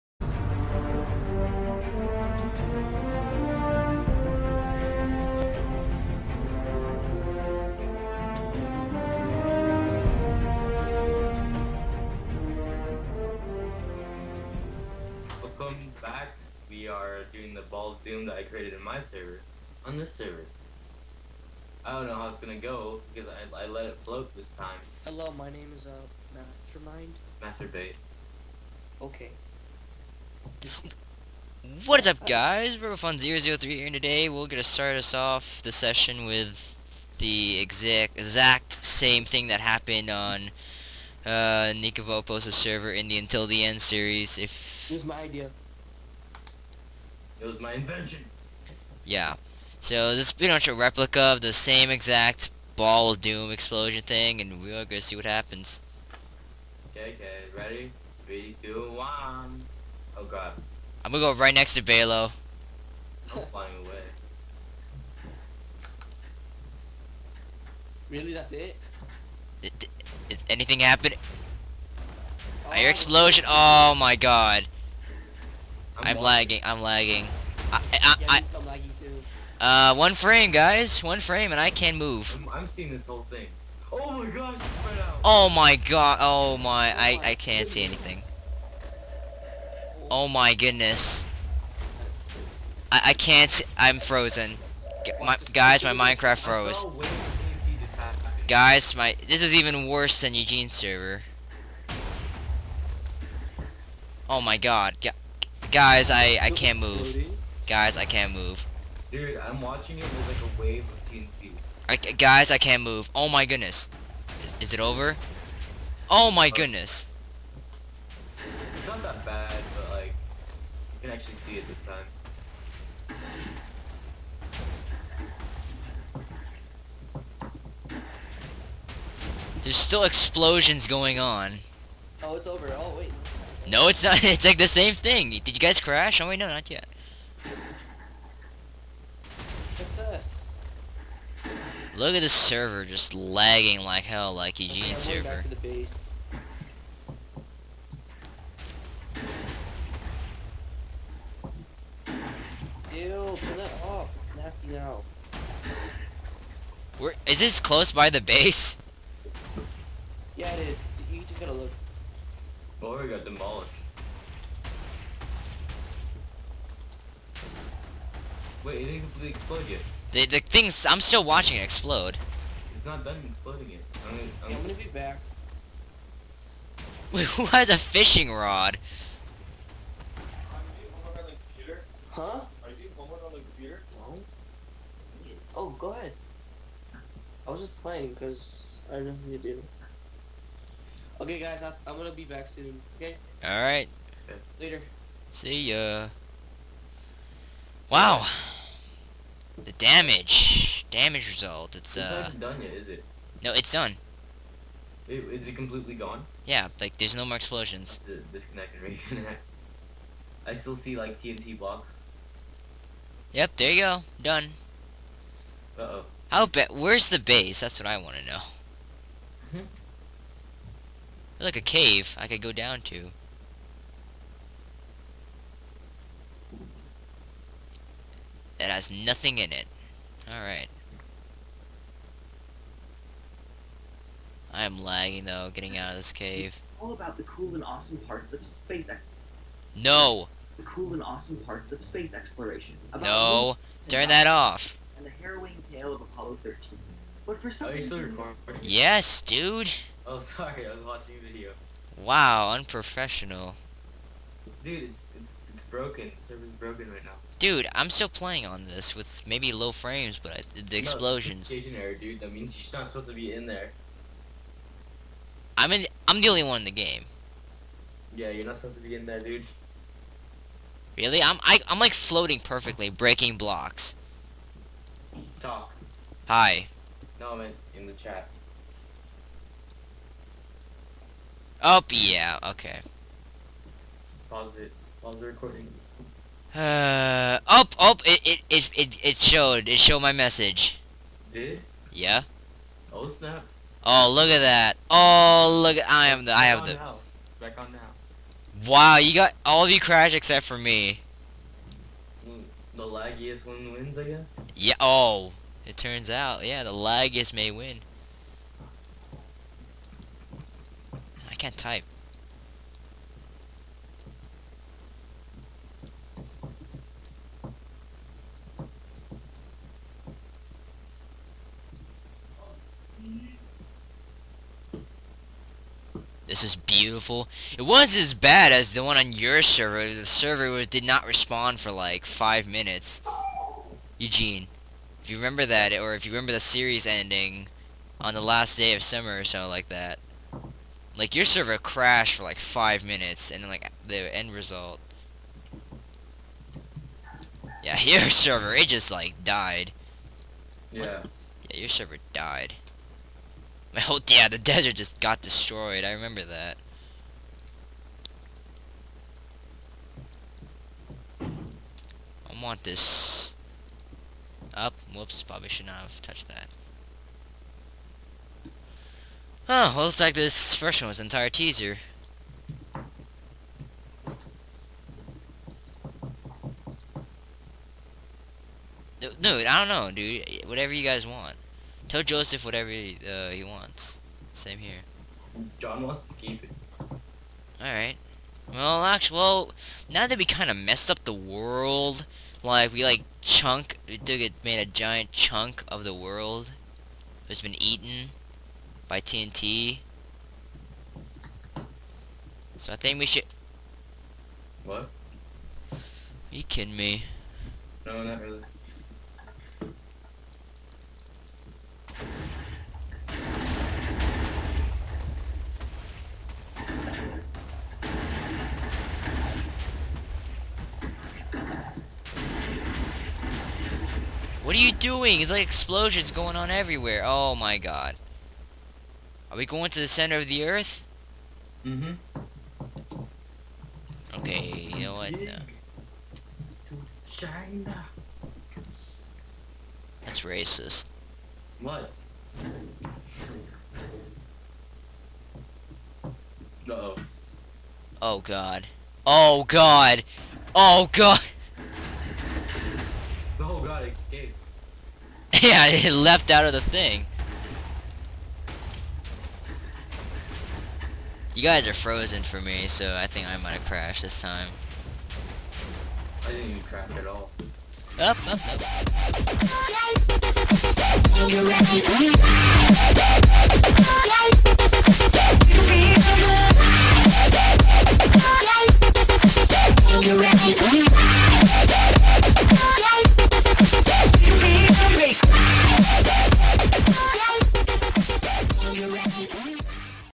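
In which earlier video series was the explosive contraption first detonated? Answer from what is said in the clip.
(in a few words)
Until the End.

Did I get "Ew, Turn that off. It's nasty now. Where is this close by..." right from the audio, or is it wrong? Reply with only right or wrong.
right.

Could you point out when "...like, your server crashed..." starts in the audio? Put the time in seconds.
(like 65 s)
341 s.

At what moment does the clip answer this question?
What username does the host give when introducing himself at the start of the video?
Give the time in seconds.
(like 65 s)
32 s.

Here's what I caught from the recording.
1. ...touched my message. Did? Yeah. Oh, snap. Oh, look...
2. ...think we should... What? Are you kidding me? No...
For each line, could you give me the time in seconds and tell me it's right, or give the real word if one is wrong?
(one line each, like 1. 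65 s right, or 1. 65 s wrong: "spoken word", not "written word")
1. 289 s wrong: "showed", not "touched"
2. 402 s right.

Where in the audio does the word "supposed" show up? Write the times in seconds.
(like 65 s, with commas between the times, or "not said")
262 s, 268 s.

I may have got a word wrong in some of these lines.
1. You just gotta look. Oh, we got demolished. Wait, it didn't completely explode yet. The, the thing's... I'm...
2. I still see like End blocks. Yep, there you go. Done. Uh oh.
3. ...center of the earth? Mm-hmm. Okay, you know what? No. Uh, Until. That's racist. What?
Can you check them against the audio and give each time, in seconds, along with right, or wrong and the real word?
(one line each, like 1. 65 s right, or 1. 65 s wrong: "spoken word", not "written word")
1. 161 s right
2. 210 s wrong: "TNT", not "End"
3. 429 s wrong: "China", not "Until".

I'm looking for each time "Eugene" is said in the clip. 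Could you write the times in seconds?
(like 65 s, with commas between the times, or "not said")
100 s, 144 s, 333 s.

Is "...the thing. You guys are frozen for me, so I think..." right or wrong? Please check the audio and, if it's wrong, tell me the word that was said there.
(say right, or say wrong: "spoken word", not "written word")
right.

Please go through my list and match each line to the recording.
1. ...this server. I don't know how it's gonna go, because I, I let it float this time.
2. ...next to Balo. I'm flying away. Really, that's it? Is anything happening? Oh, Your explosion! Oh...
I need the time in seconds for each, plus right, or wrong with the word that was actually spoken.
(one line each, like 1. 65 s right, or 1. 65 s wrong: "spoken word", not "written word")
1. 19 s right
2. 61 s right.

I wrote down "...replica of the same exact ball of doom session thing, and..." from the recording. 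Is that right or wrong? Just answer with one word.
wrong.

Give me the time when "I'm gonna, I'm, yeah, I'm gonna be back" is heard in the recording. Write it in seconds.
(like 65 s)
174 s.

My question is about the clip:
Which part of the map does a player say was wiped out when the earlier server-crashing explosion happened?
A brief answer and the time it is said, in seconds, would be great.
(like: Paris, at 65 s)
The desert, at 354 s.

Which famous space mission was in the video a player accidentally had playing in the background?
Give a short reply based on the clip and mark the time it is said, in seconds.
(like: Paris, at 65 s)
Apollo 13, at 246 s.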